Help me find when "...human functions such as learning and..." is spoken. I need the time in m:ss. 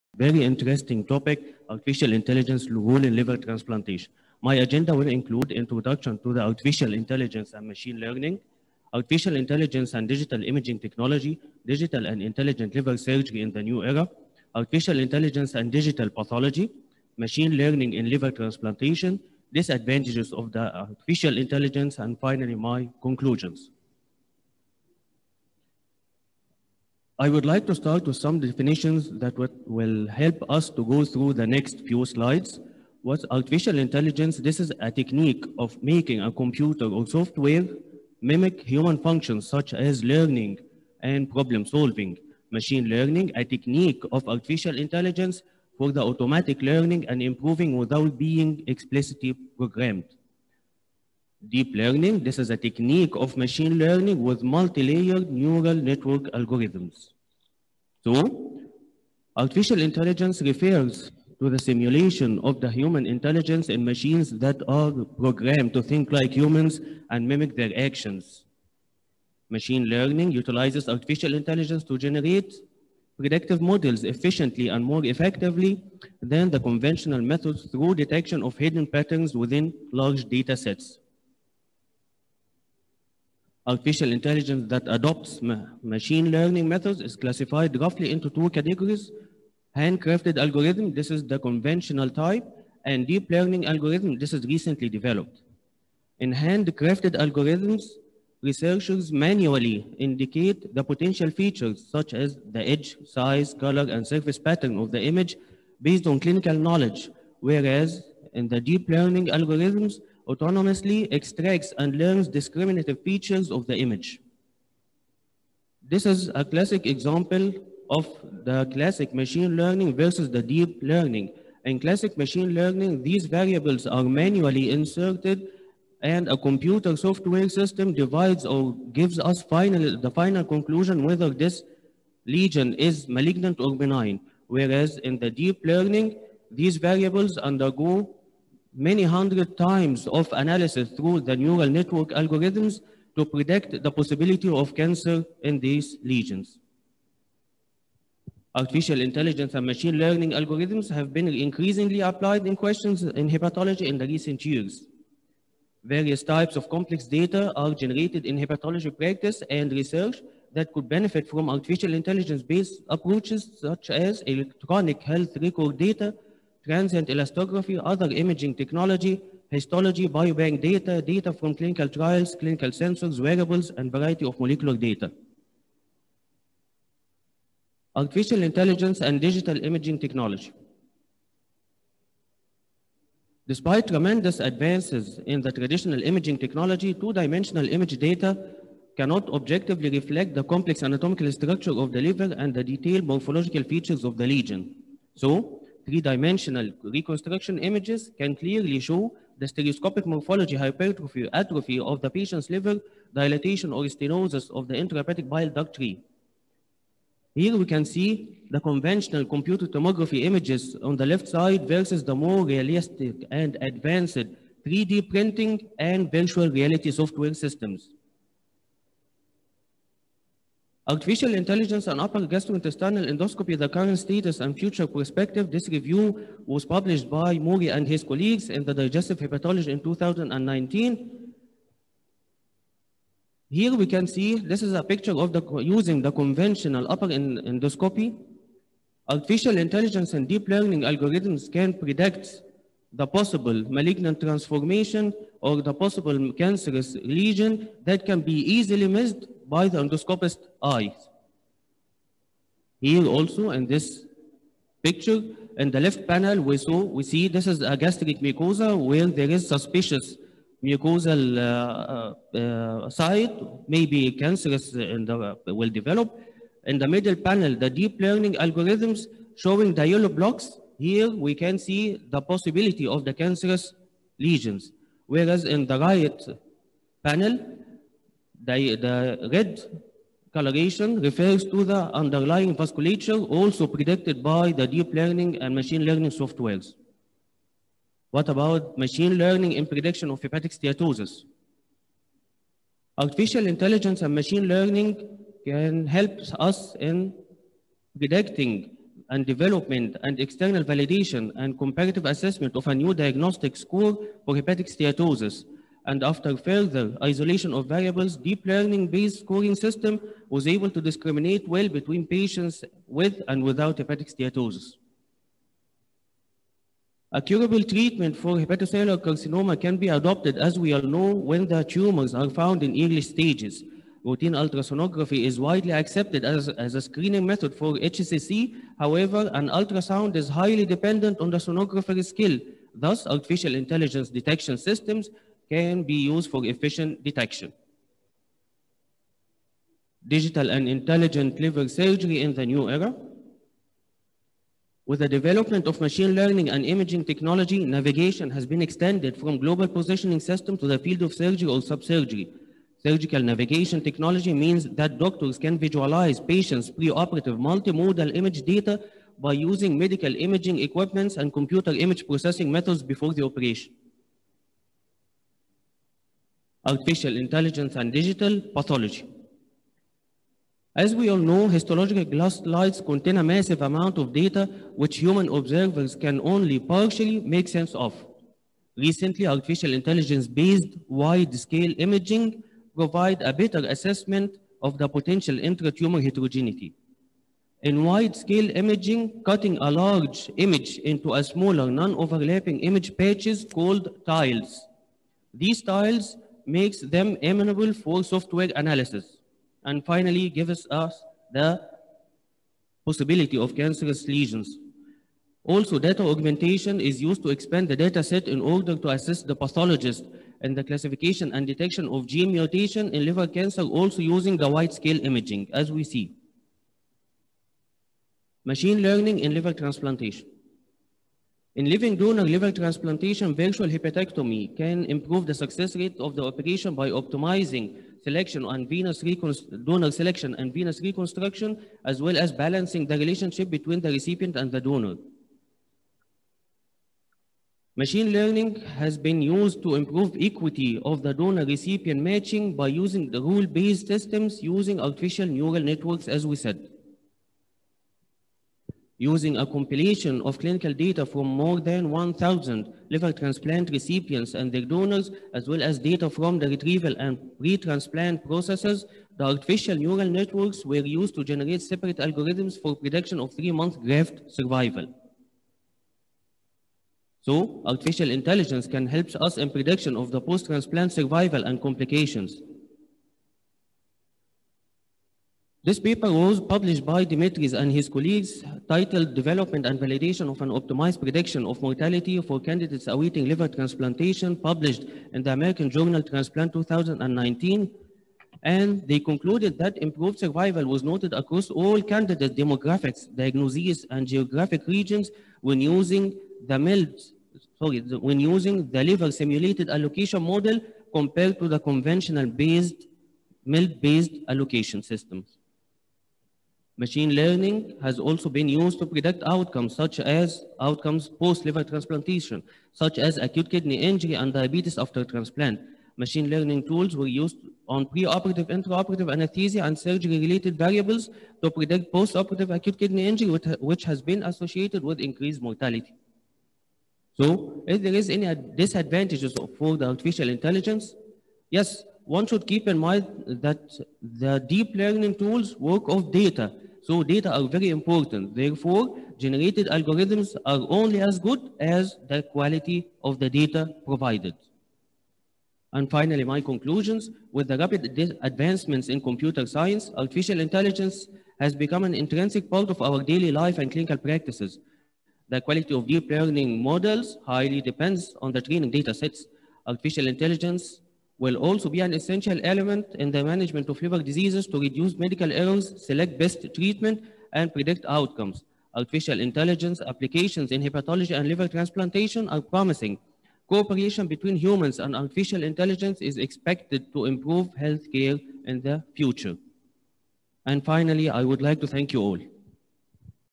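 0:38.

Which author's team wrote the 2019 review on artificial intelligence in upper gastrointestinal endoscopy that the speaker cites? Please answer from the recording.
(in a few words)
Mori.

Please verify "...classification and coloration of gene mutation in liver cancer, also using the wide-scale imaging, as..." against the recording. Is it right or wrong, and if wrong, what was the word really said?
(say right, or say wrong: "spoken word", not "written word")
wrong: "detection", not "coloration".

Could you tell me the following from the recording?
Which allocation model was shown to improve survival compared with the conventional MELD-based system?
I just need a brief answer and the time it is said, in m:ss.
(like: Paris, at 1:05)
Liver simulated allocation model, at 8:18.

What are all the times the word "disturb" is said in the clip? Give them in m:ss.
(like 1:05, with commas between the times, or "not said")
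not said.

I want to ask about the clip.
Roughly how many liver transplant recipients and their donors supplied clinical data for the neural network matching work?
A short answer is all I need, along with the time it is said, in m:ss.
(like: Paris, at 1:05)
More than 1,000, at 7:31.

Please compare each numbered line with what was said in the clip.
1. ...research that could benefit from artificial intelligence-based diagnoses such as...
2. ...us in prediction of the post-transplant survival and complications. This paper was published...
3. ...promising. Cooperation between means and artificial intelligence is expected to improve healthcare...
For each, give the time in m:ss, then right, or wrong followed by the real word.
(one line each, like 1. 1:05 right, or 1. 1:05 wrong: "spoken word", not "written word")
1. 2:39 wrong: "approaches", not "diagnoses"
2. 7:49 right
3. 9:32 wrong: "humans", not "means".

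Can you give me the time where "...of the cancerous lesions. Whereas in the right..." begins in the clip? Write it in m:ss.
4:32.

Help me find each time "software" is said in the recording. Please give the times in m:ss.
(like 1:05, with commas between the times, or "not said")
0:37, 2:06, 3:36, 4:46, 6:38.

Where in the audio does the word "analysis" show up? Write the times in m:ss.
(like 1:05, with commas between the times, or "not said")
2:20, 6:38.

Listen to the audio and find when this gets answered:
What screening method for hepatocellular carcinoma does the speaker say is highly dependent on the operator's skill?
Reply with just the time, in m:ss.
5:24.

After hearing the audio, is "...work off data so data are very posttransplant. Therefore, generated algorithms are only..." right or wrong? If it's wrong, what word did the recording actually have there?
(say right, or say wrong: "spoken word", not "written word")
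wrong: "important", not "posttransplant".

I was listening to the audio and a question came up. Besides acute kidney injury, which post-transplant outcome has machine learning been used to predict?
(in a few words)
Diabetes.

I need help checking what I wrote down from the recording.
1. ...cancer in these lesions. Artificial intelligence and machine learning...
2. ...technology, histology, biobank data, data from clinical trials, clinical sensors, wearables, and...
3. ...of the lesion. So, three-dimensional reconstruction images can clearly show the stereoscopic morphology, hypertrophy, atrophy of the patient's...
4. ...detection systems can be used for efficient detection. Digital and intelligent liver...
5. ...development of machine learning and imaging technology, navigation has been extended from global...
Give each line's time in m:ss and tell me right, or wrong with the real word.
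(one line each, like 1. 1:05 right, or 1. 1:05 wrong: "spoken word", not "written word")
1. 2:24 right
2. 2:48 right
3. 3:14 right
4. 5:34 right
5. 5:45 right.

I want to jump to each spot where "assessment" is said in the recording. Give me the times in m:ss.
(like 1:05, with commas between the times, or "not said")
5:02, 6:23.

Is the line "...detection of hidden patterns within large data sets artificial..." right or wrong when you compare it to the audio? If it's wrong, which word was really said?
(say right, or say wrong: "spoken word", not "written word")
right.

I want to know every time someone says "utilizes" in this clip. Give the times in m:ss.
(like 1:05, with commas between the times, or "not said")
1:10.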